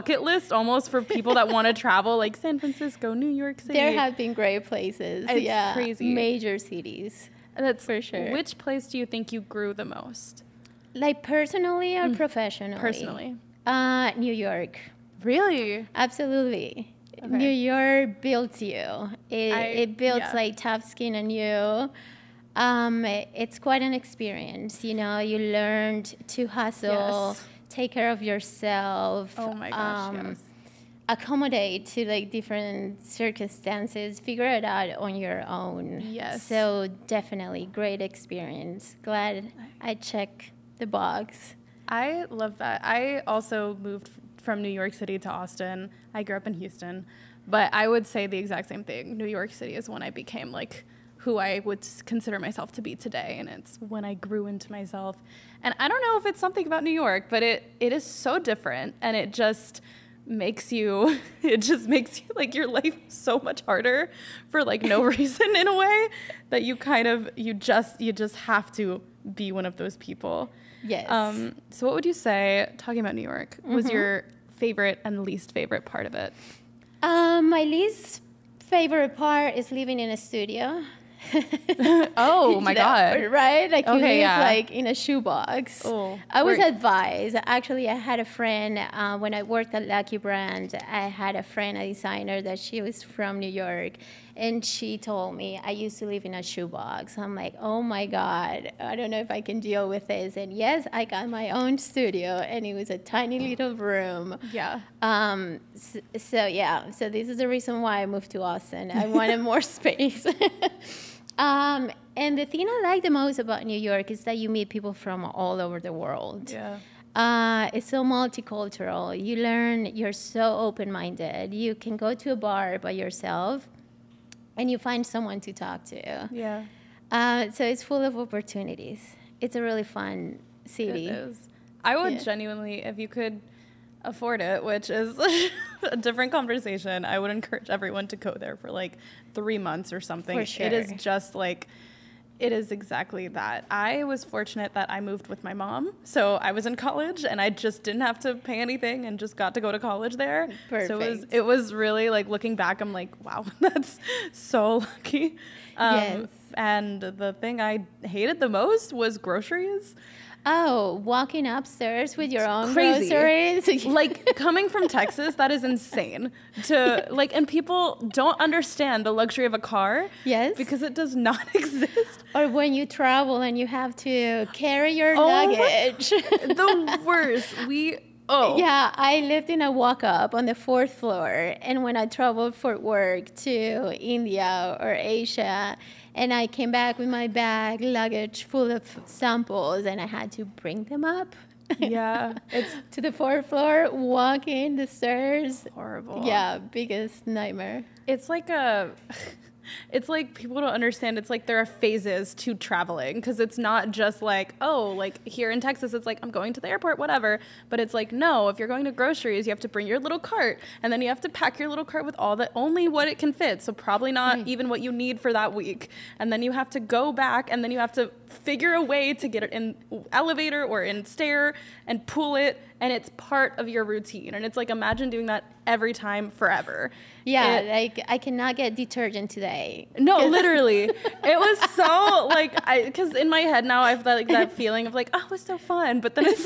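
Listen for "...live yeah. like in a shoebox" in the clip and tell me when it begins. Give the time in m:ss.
1:24.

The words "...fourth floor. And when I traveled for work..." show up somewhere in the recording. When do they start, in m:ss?
3:00.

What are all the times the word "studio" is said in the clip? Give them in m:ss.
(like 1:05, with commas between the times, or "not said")
1:20, 1:41.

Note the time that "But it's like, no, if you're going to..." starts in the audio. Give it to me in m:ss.
3:27.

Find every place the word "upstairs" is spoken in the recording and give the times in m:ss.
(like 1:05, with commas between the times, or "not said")
2:41.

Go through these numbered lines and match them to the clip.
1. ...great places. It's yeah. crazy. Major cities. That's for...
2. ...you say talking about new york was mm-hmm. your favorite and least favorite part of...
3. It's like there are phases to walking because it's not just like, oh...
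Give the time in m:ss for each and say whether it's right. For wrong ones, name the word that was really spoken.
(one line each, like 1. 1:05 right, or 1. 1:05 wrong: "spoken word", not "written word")
1. 0:04 right
2. 1:12 right
3. 3:21 wrong: "traveling", not "walking".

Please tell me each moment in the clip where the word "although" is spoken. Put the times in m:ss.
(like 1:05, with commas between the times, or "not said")
not said.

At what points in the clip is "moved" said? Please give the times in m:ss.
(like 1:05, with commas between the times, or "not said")
0:43, 1:48, 2:25.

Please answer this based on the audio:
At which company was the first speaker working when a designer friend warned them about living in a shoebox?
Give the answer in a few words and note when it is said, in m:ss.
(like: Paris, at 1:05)
Lucky Brand, at 1:29.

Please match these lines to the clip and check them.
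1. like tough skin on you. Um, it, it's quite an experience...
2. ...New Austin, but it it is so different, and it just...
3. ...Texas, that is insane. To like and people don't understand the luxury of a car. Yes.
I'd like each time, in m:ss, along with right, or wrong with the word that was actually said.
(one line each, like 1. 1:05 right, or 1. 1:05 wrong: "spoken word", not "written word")
1. 0:20 right
2. 0:56 wrong: "York", not "Austin"
3. 2:44 right.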